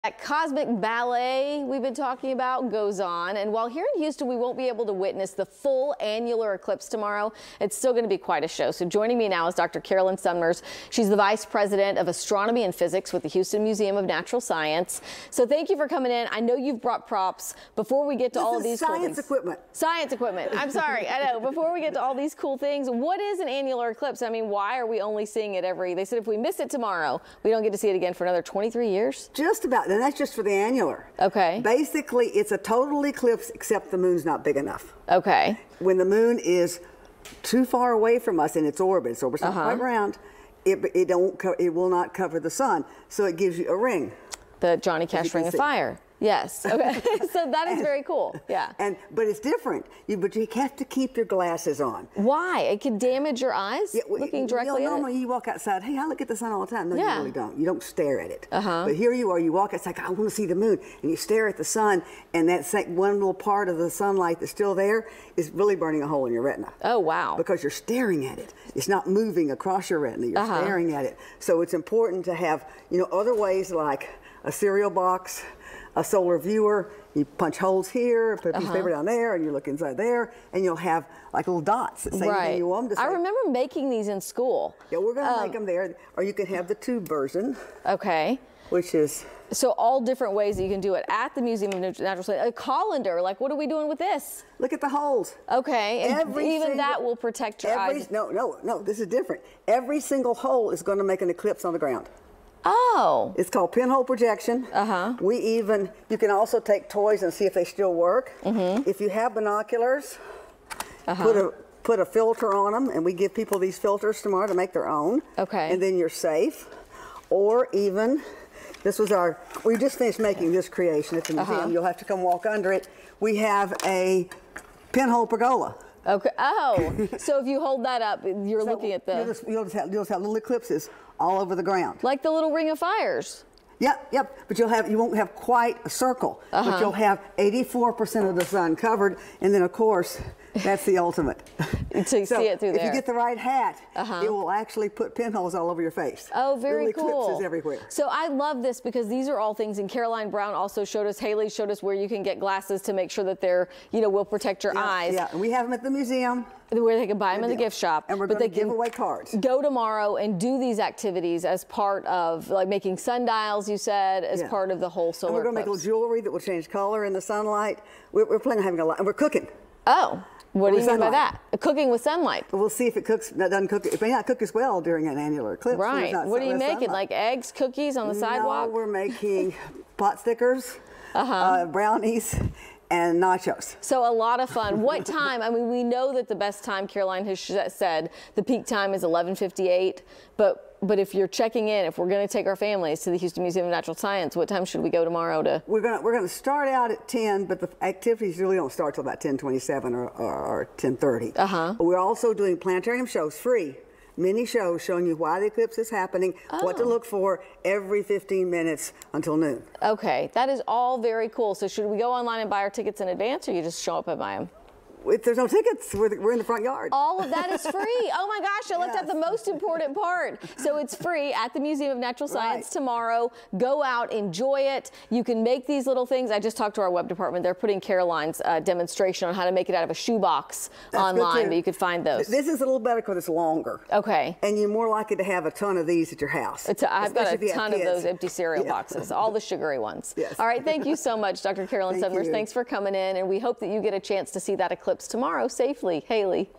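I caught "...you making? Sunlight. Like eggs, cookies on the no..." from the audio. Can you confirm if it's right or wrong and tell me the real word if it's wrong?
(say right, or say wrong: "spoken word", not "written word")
right.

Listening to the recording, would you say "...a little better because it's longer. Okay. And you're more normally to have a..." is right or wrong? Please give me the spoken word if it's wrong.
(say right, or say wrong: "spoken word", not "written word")
wrong: "likely", not "normally".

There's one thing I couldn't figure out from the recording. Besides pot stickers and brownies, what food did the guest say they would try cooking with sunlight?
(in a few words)
nachos.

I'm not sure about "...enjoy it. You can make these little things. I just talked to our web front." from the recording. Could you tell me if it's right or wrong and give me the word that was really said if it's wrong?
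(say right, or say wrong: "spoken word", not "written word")
wrong: "department", not "front".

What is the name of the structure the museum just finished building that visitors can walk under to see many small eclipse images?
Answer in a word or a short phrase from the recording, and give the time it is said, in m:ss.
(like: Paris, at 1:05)
pinhole pergola, at 2:04.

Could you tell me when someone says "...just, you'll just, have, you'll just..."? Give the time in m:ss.
2:09.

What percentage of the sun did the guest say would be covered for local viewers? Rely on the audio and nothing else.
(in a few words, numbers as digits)
84%.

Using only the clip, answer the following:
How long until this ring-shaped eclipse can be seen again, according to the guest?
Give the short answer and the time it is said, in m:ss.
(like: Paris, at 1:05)
23 years, at 0:28.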